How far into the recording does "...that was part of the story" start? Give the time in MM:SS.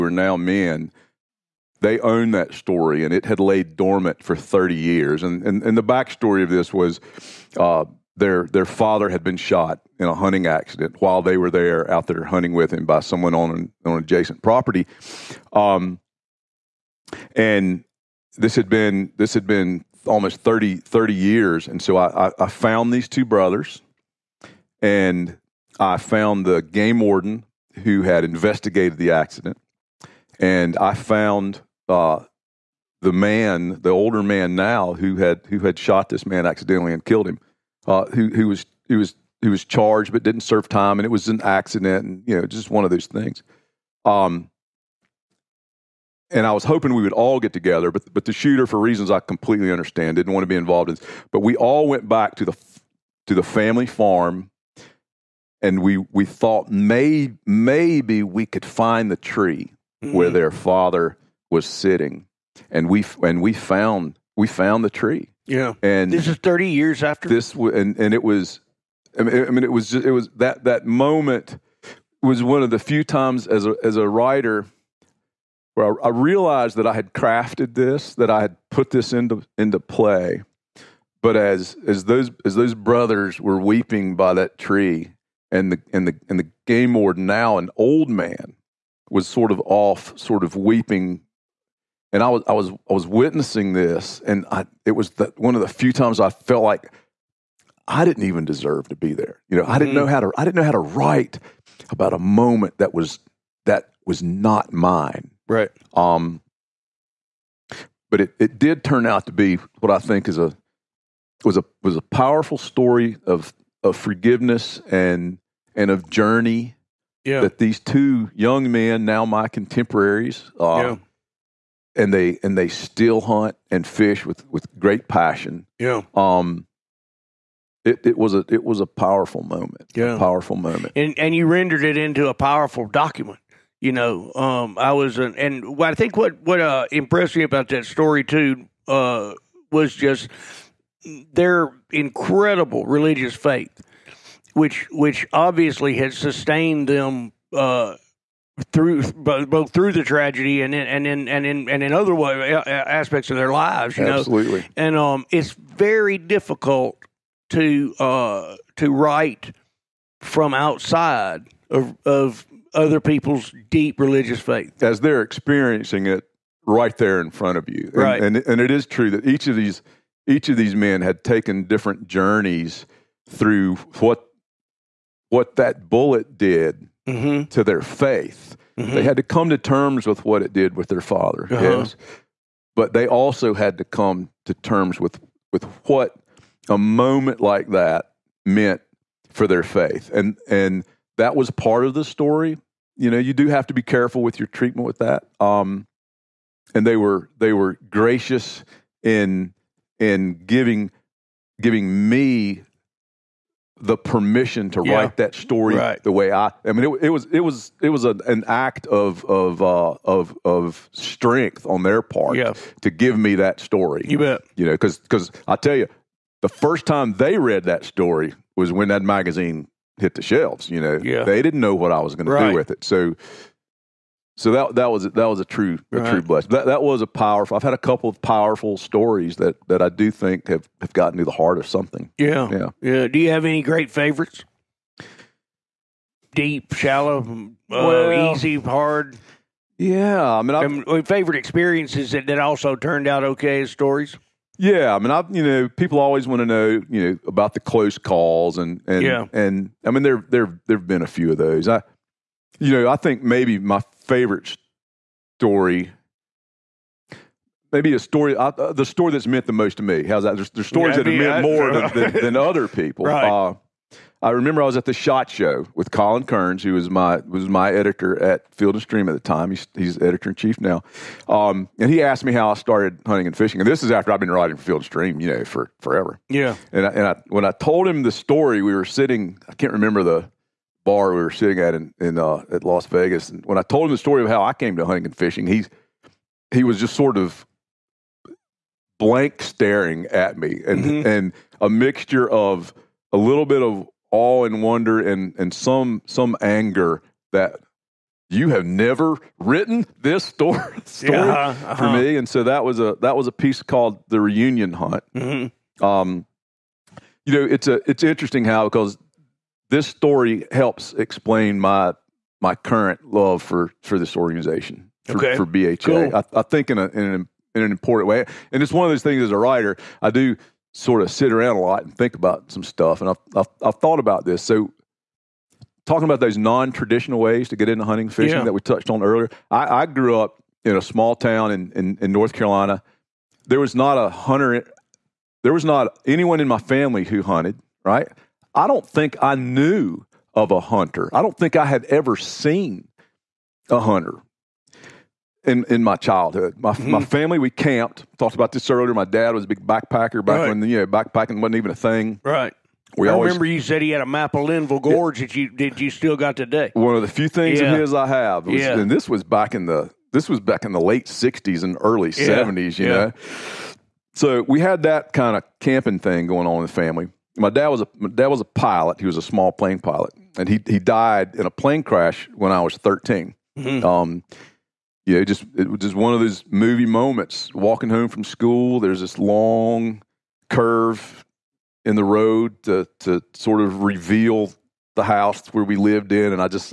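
03:11.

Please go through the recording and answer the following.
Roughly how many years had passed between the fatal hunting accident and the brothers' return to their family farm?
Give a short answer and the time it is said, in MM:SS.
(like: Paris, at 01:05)
30, at 01:06.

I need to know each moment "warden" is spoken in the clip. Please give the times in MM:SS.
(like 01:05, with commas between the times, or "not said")
00:27, 01:26.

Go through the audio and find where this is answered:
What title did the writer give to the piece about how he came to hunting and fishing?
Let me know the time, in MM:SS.
05:04.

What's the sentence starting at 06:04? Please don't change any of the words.
So we had that kind of camping thing going on in the family my dad was a my dad was a pilot.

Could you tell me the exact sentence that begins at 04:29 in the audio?
He's, he's editor in chief now, um, and he asked me how I started hunting and fishing.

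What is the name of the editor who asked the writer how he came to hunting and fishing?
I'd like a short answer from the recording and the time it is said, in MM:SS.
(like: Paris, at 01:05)
Colin Kearns, at 04:25.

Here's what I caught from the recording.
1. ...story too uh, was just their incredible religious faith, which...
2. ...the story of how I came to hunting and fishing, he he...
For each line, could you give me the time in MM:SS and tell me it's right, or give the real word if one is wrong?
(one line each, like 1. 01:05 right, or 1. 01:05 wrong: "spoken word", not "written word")
1. 02:17 right
2. 04:43 right.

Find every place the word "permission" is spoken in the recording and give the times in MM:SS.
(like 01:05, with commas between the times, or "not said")
03:23.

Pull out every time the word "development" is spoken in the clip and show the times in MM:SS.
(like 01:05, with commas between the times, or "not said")
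not said.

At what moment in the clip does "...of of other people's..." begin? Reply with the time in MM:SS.
02:41.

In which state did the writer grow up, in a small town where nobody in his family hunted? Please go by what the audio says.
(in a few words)
North Carolina.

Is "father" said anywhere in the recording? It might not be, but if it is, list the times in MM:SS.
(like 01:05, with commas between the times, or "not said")
00:08, 01:00, 03:01.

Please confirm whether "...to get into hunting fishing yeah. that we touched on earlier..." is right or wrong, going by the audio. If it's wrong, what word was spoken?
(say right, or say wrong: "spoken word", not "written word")
right.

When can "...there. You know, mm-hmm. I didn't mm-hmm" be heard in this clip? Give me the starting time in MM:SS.
01:39.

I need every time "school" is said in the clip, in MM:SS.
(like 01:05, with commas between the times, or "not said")
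06:18.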